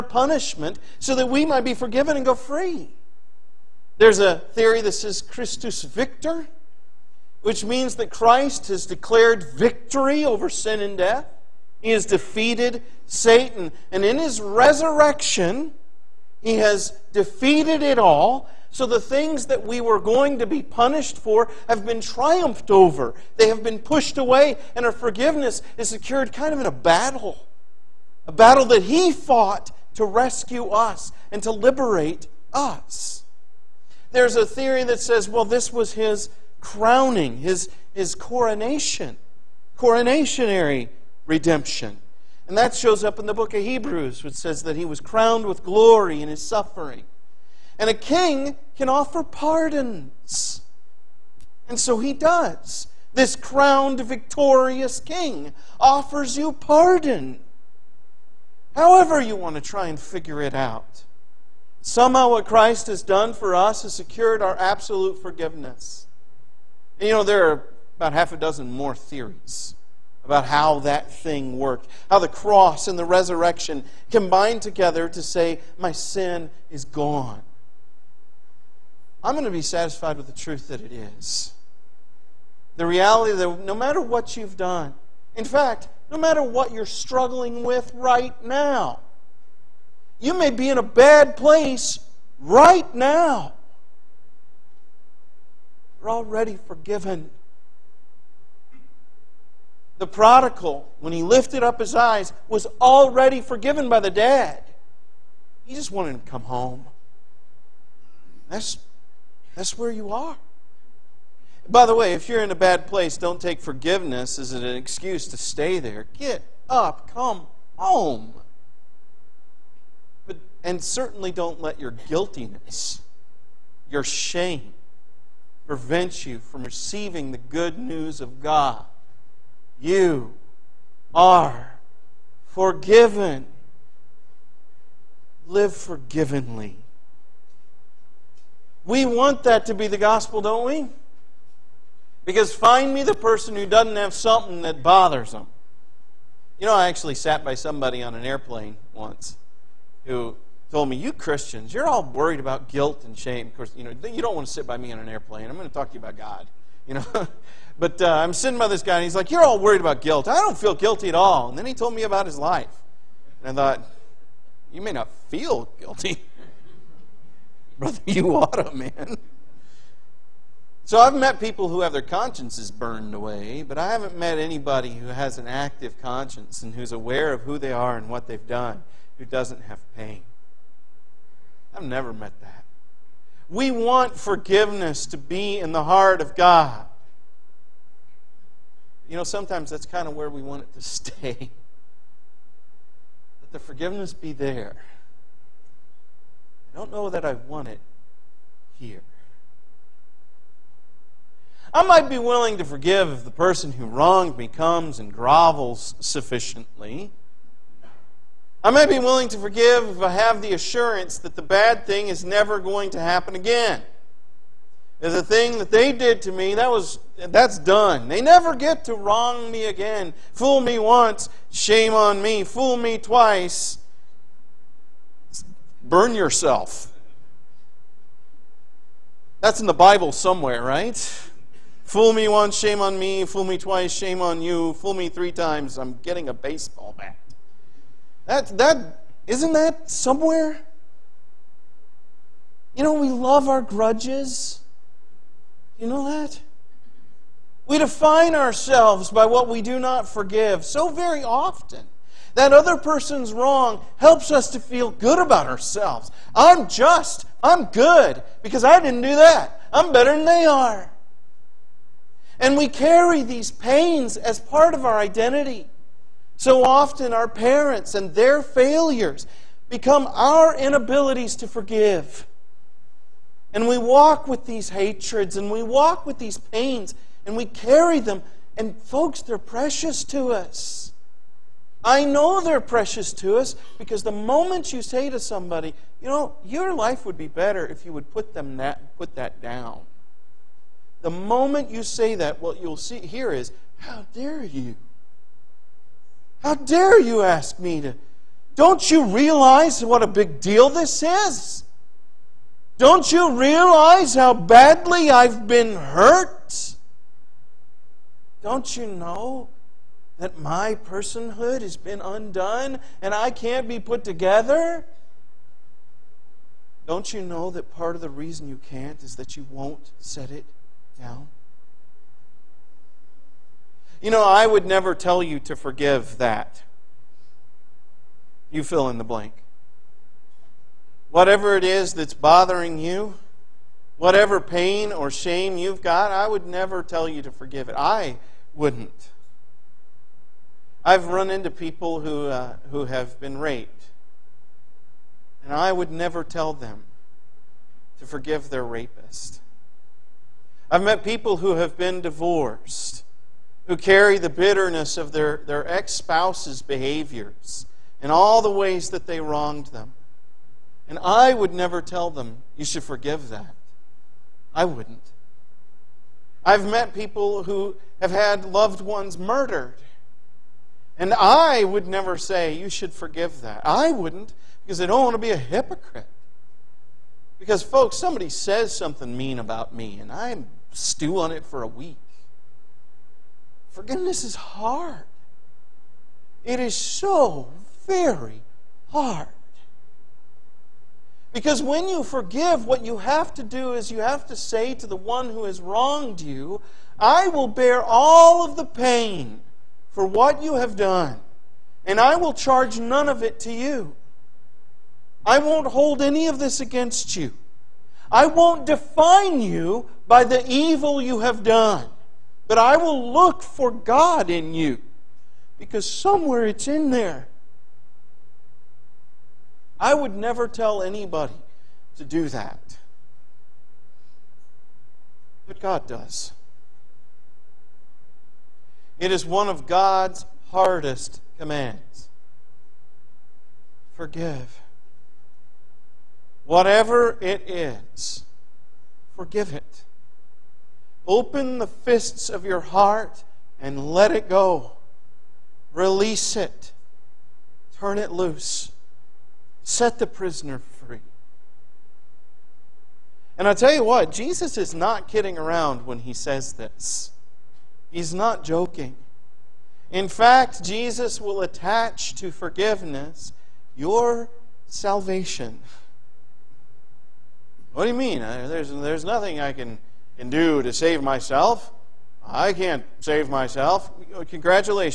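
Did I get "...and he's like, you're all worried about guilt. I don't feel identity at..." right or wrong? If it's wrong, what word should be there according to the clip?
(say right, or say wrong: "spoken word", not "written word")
wrong: "guilty", not "identity".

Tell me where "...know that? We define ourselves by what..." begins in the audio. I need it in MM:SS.
04:05.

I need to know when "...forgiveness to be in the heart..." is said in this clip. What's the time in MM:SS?
03:04.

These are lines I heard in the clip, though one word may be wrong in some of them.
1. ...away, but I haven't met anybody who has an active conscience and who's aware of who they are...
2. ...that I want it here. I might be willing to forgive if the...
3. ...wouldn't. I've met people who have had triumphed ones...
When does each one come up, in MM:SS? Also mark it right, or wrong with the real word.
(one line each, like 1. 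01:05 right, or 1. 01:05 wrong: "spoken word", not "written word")
1. 02:53 right
2. 03:17 right
3. 06:04 wrong: "loved", not "triumphed".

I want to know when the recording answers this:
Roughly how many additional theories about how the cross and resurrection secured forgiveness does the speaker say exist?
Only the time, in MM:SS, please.
01:08.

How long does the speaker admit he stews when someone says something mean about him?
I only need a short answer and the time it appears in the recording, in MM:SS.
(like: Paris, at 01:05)
A week, at 06:21.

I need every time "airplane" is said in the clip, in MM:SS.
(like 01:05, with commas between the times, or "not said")
02:28, 02:35.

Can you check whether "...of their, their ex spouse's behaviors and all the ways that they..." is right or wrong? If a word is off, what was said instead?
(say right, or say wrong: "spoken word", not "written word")
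right.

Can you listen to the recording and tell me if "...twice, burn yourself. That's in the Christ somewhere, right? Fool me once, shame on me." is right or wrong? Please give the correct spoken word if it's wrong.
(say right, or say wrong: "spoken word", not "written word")
wrong: "Bible", not "Christ".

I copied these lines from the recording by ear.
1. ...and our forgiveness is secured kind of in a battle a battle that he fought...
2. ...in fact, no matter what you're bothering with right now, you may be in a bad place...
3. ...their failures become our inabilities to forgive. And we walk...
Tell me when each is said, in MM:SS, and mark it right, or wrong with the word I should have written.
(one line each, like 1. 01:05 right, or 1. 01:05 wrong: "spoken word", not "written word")
1. 00:24 right
2. 01:25 wrong: "struggling", not "bothering"
3. 04:28 right.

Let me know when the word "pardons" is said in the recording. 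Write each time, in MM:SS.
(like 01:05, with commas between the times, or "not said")
00:49, 00:56.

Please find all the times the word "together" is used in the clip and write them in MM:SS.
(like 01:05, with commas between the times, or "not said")
01:14, 05:14.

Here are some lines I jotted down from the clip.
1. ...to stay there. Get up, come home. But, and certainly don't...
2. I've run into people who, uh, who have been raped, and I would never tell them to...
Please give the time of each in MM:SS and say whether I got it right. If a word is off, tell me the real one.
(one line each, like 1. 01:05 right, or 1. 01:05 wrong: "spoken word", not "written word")
1. 01:55 right
2. 05:40 right.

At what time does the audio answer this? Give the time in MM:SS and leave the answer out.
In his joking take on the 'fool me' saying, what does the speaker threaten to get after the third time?
03:56.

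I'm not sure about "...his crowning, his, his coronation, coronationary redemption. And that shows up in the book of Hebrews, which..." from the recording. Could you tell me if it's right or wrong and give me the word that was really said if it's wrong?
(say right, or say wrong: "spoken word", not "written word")
right.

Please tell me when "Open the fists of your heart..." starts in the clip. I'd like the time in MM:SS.
07:21.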